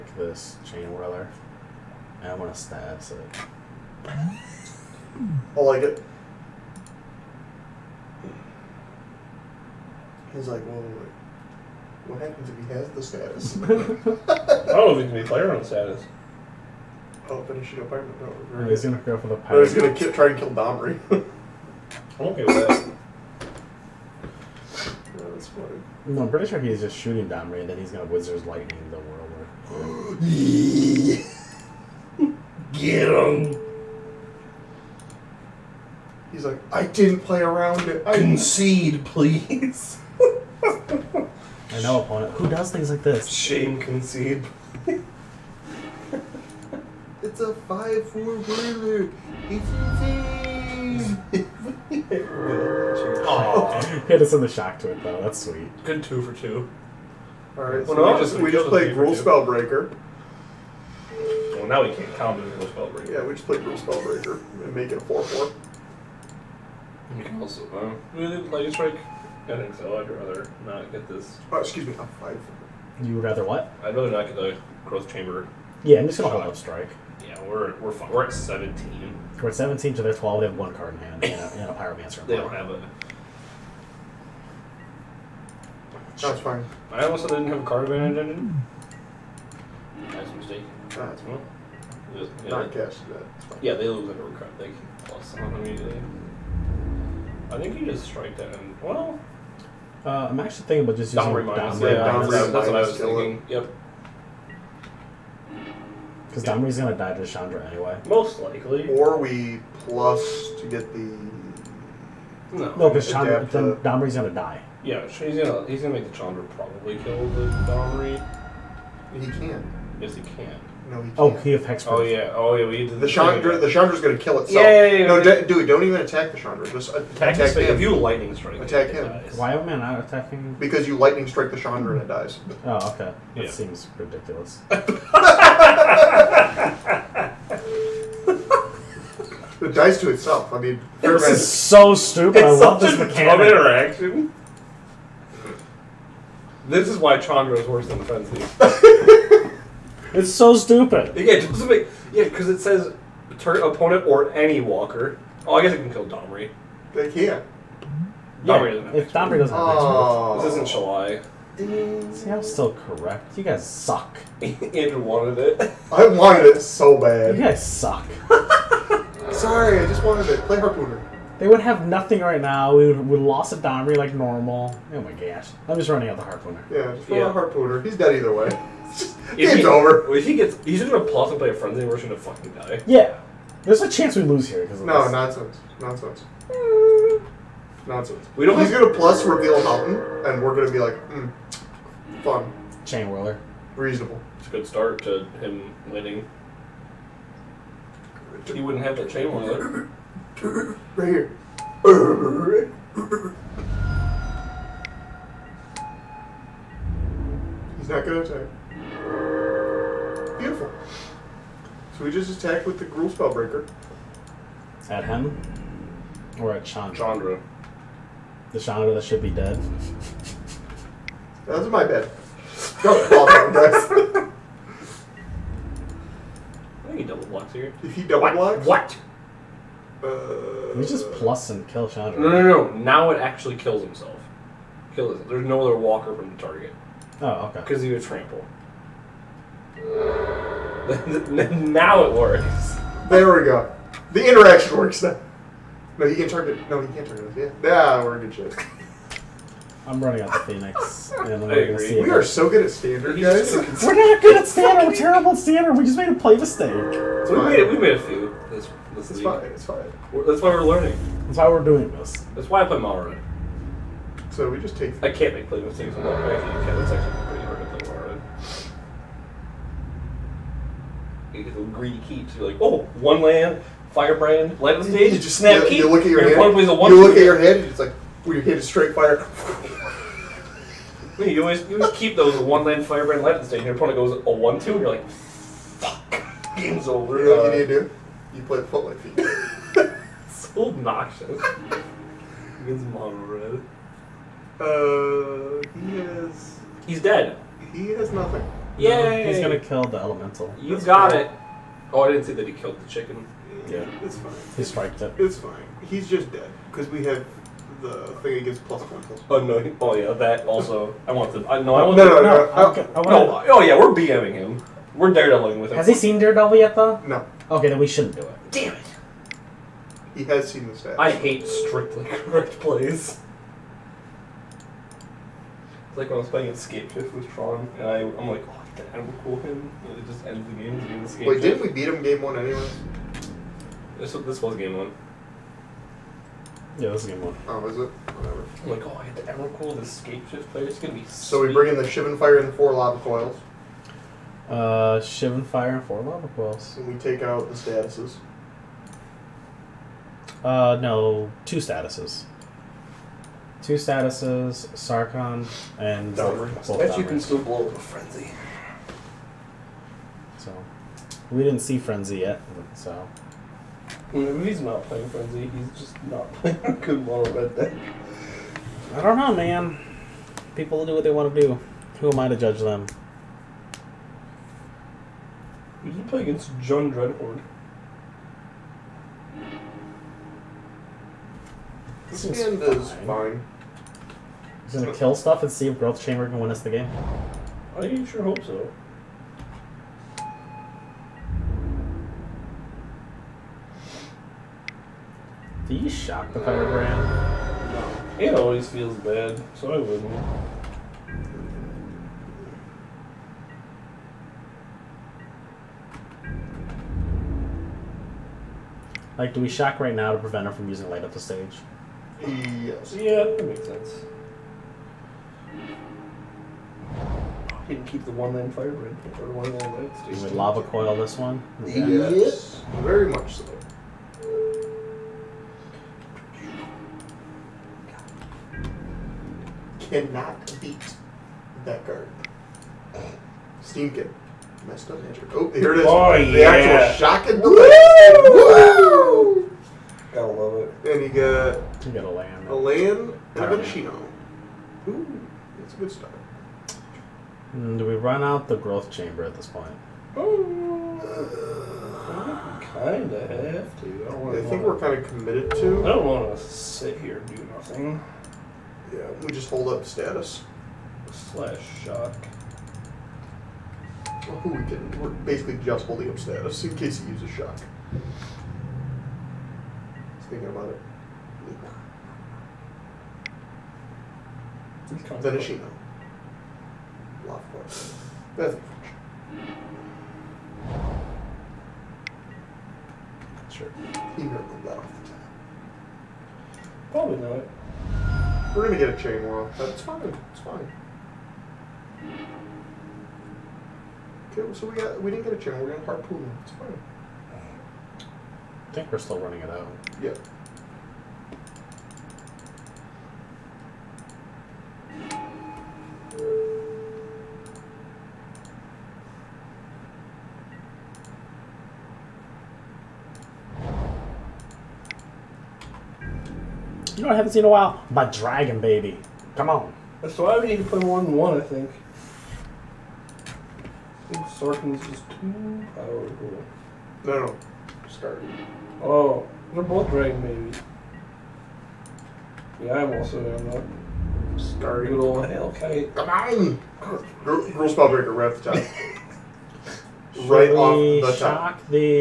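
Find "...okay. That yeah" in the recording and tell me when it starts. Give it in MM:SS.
02:12.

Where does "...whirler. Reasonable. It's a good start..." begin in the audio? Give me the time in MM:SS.
03:13.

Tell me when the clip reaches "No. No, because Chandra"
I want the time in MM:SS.
01:52.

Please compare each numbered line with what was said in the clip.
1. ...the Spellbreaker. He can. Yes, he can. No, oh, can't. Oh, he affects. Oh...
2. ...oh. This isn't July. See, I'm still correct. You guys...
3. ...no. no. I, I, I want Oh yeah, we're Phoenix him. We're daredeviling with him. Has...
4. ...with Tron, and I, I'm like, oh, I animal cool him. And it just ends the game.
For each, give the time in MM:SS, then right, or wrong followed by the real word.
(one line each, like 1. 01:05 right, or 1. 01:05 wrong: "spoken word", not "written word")
1. 01:57 wrong: "Domri", not "Spellbreaker"
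2. 02:39 right
3. 05:12 wrong: "BMing", not "Phoenix"
4. 05:27 right.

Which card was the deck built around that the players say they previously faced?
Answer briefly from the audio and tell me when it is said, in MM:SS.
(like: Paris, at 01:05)
Dreadhorde, at 06:15.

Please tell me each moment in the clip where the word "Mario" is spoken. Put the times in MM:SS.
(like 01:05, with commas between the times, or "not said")
04:26.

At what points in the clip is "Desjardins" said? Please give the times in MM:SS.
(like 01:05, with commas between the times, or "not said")
not said.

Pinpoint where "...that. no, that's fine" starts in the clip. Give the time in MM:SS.
00:22.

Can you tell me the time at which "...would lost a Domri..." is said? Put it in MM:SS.
02:53.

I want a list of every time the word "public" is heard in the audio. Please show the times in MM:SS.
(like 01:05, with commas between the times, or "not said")
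04:48.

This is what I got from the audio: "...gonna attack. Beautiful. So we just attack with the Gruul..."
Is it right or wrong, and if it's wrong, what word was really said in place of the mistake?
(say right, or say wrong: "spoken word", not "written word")
right.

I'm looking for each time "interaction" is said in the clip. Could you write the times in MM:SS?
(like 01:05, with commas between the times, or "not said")
02:23, 04:04.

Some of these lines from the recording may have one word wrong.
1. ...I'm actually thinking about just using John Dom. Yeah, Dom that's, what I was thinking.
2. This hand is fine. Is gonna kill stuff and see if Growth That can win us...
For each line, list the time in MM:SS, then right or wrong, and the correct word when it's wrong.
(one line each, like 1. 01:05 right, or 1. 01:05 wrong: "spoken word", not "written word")
1. 01:40 wrong: "Dom", not "John"
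2. 06:22 wrong: "Chamber", not "That".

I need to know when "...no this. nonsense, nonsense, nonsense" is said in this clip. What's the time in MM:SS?
03:04.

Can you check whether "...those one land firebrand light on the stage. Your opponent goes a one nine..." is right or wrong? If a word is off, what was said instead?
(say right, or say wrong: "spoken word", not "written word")
wrong: "two", not "nine".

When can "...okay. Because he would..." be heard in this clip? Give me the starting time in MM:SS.
03:57.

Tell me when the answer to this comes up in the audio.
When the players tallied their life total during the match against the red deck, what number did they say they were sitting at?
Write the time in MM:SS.
01:19.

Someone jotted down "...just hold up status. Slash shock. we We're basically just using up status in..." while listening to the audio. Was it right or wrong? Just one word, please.
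wrong.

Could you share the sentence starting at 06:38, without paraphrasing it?
It always feels bad, so I wouldn't.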